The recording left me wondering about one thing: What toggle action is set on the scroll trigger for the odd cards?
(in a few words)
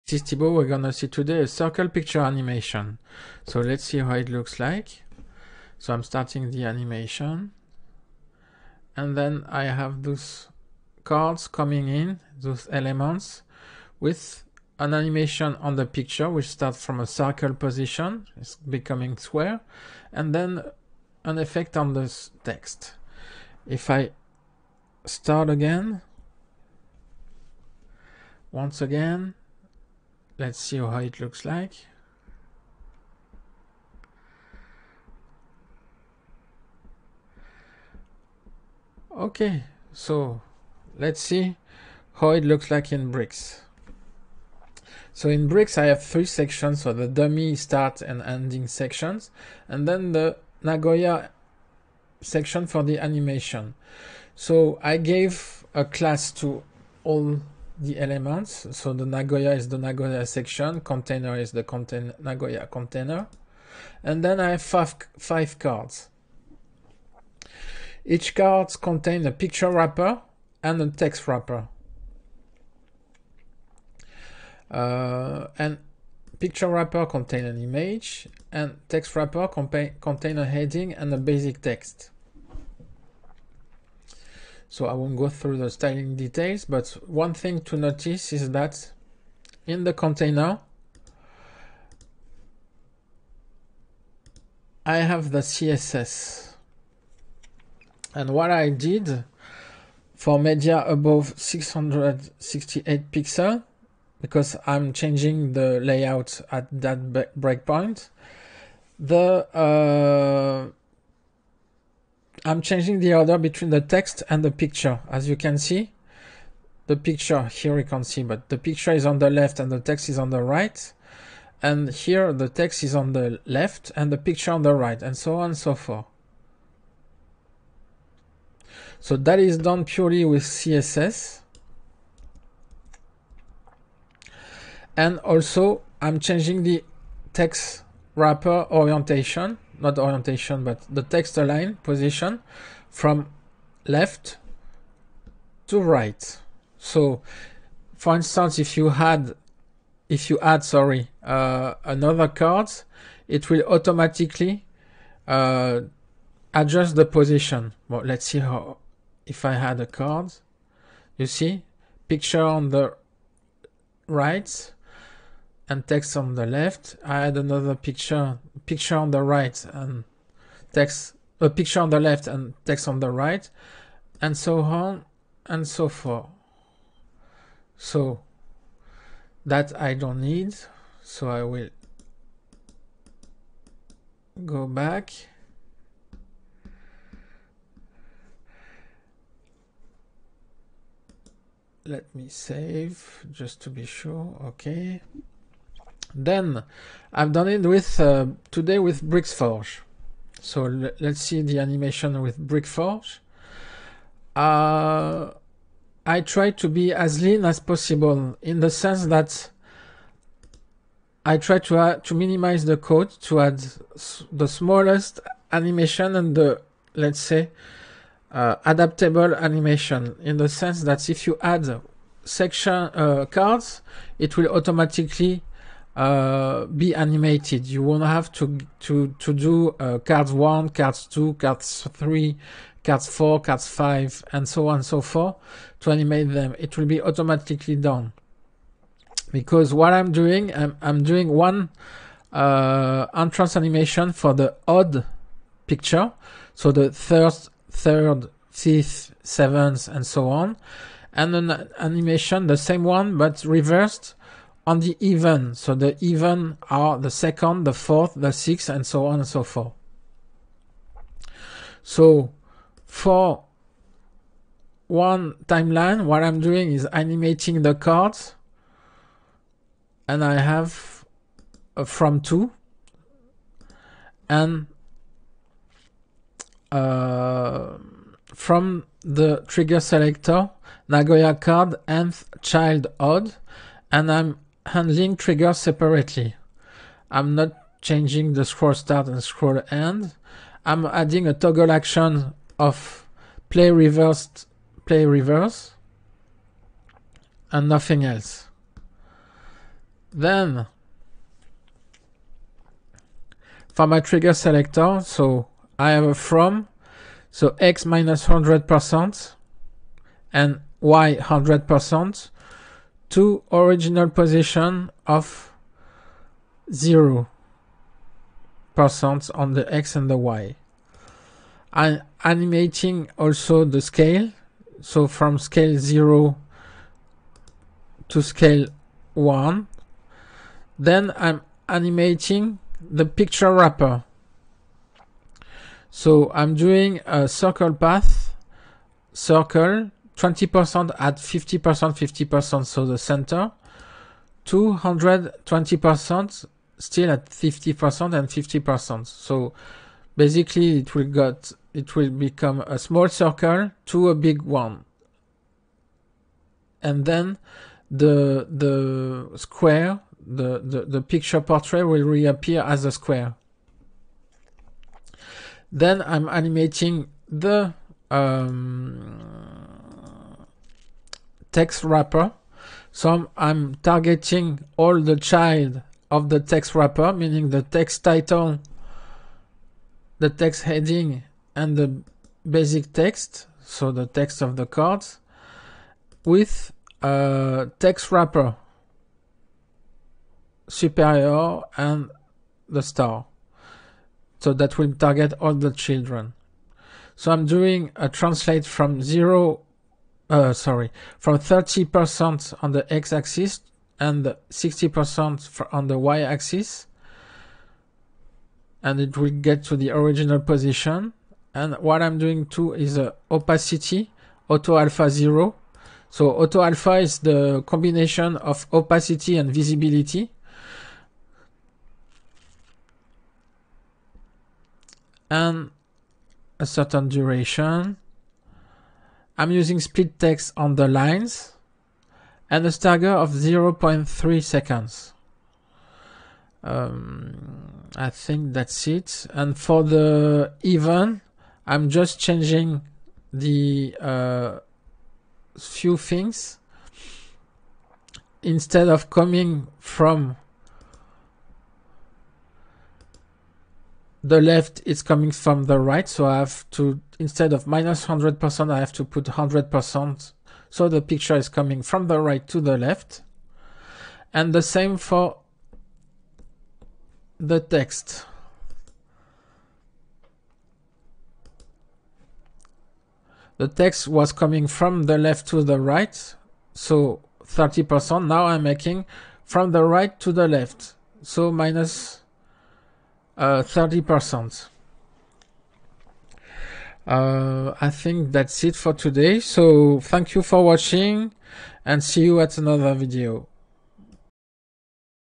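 play reverse.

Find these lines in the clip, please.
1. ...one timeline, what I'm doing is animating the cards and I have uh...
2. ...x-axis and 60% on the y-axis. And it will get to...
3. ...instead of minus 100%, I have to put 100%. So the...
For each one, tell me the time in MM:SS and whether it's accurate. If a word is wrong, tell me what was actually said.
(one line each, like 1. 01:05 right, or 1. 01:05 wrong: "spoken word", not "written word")
1. 04:24 right
2. 06:42 right
3. 07:37 right.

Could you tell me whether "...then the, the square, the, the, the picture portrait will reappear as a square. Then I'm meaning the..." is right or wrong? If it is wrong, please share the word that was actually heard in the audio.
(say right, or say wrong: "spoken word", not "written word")
wrong: "animating", not "meaning".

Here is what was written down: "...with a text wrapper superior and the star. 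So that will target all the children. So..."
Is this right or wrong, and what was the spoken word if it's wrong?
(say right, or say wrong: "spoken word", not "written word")
right.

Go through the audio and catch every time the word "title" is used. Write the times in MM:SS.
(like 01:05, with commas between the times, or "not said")
06:18.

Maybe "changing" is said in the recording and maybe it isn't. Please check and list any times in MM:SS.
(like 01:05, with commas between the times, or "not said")
01:44, 01:52, 02:16, 04:47, 07:22.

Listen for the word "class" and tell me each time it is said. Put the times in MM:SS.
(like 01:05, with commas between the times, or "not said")
00:55.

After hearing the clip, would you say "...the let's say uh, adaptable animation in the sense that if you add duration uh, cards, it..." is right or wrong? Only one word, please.
wrong.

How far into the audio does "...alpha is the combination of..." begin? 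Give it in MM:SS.
06:56.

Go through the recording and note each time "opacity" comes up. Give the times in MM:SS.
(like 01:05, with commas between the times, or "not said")
06:53, 06:58.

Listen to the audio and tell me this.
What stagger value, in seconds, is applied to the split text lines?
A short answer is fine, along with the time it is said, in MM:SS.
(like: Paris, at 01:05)
0.3, at 07:13.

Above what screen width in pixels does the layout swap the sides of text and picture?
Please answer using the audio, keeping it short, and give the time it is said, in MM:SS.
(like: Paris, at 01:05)
668, at 01:41.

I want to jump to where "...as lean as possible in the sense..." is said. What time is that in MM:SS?
03:26.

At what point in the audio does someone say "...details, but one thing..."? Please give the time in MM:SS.
01:26.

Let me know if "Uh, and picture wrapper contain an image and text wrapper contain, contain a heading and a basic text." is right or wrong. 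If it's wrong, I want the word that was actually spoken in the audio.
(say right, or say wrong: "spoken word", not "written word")
right.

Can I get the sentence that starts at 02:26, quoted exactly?
So, for instance, if you had, if you add, sorry, uh, another card, it will automatically uh, adjust the position.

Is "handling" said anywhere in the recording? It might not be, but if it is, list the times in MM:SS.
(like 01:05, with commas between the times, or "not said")
04:44.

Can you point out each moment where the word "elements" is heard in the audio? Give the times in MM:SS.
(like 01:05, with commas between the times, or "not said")
00:12, 00:57.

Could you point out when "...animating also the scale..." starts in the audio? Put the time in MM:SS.
05:22.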